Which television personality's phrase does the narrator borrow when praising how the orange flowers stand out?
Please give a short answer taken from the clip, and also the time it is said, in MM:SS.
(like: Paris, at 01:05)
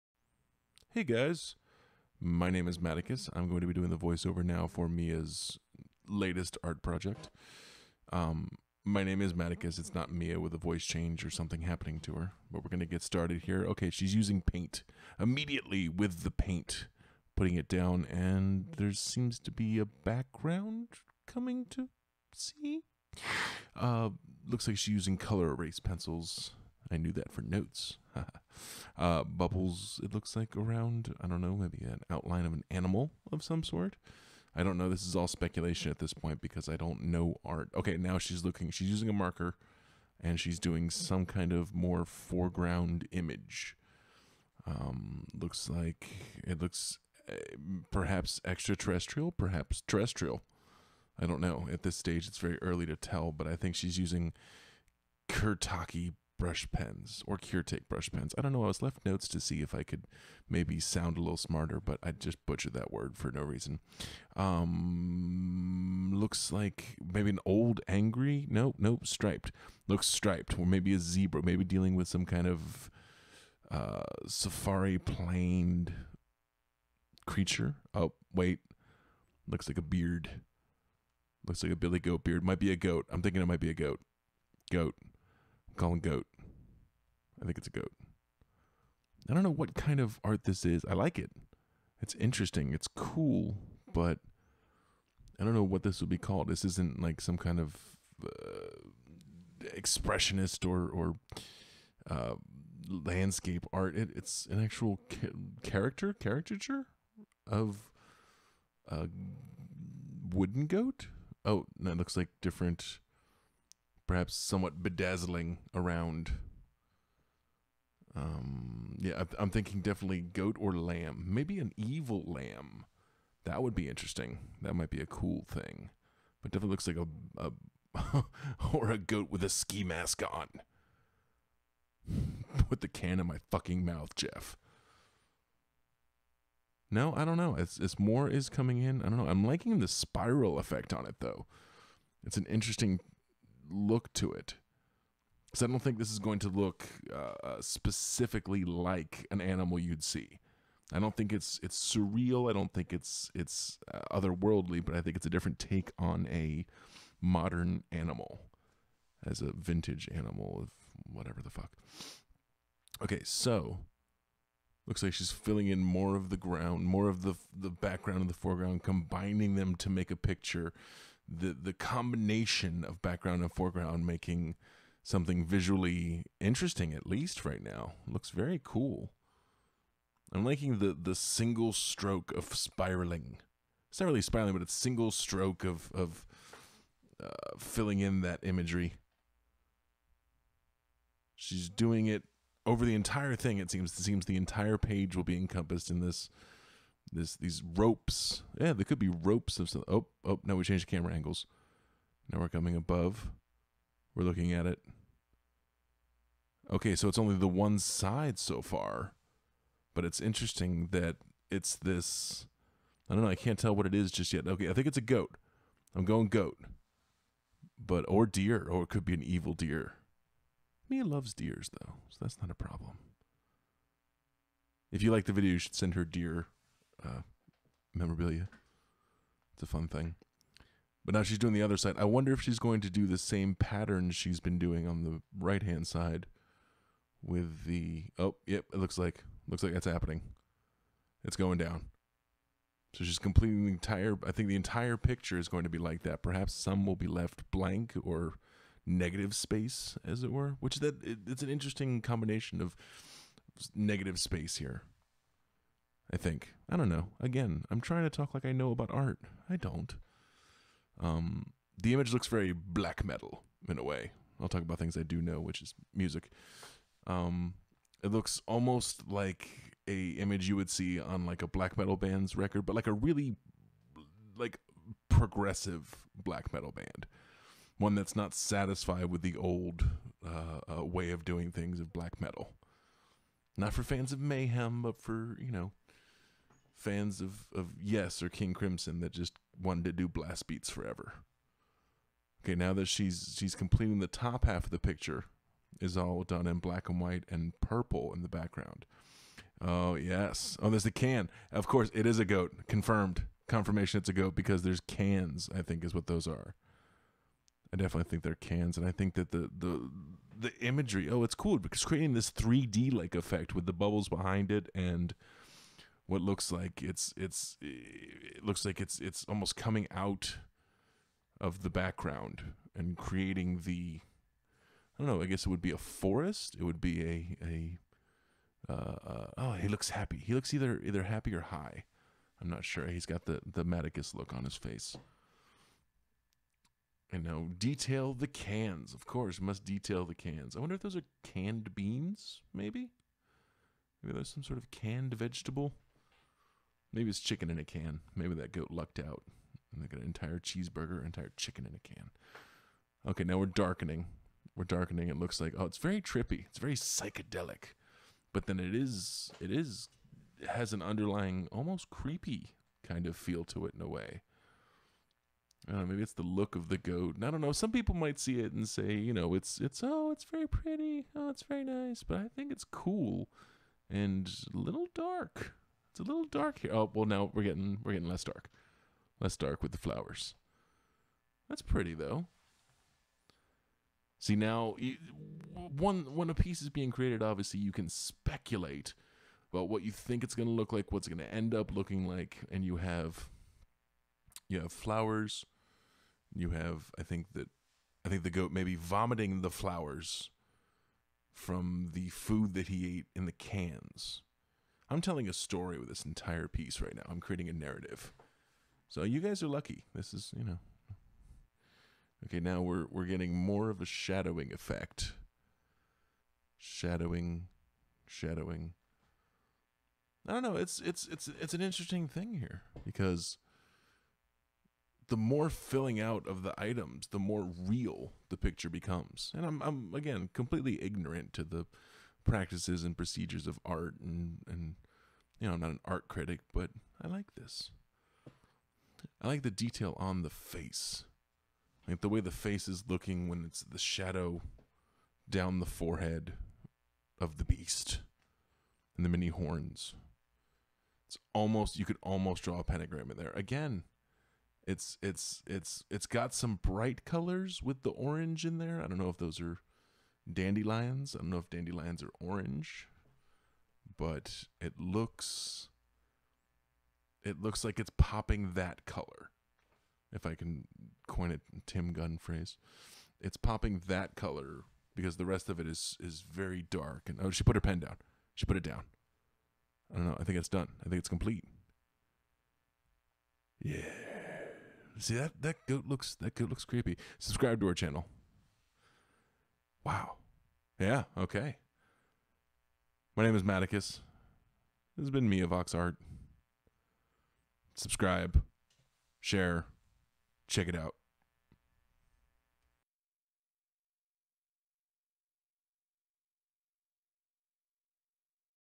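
Tim Gunn, at 07:51.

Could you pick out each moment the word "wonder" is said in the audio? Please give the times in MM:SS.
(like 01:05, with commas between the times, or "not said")
03:52, 05:40.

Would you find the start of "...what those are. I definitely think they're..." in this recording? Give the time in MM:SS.
05:05.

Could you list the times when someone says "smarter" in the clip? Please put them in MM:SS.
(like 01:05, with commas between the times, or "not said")
01:01.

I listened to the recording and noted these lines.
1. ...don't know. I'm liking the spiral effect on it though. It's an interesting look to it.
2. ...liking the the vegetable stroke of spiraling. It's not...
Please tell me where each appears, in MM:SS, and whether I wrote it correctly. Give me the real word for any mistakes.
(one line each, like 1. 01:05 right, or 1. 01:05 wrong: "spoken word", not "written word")
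1. 02:19 right
2. 03:00 wrong: "single", not "vegetable".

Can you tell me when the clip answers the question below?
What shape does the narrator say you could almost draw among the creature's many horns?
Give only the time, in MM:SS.
07:32.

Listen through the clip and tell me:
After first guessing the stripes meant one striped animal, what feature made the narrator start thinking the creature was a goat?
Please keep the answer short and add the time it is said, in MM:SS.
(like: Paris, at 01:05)
a billy goat beard, at 01:21.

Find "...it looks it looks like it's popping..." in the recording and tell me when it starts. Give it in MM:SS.
07:44.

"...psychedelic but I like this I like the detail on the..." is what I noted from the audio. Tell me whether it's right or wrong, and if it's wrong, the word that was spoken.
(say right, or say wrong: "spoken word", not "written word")
wrong: "critic", not "psychedelic".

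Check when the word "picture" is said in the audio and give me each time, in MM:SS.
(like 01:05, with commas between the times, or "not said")
02:50, 04:04, 04:54, 07:08.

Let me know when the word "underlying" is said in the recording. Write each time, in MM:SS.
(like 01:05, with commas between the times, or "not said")
06:00.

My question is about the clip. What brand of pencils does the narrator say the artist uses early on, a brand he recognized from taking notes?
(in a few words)
Col-erase.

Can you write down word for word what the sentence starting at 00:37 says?
Okay, now she's looking, she's using a marker and she's doing some kind of more foreground image.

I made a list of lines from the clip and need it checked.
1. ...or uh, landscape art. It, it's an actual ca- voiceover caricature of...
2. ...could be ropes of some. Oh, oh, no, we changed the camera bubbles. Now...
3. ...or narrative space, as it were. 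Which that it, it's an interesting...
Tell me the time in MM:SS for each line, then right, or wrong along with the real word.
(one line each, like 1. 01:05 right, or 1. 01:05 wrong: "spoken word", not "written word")
1. 01:40 wrong: "character", not "voiceover"
2. 03:18 wrong: "angles", not "bubbles"
3. 04:08 wrong: "negative", not "narrative".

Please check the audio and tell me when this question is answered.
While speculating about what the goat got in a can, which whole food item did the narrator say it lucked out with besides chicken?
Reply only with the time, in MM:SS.
05:50.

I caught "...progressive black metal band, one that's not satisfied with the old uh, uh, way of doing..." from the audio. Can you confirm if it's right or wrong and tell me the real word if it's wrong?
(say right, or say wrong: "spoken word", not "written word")
right.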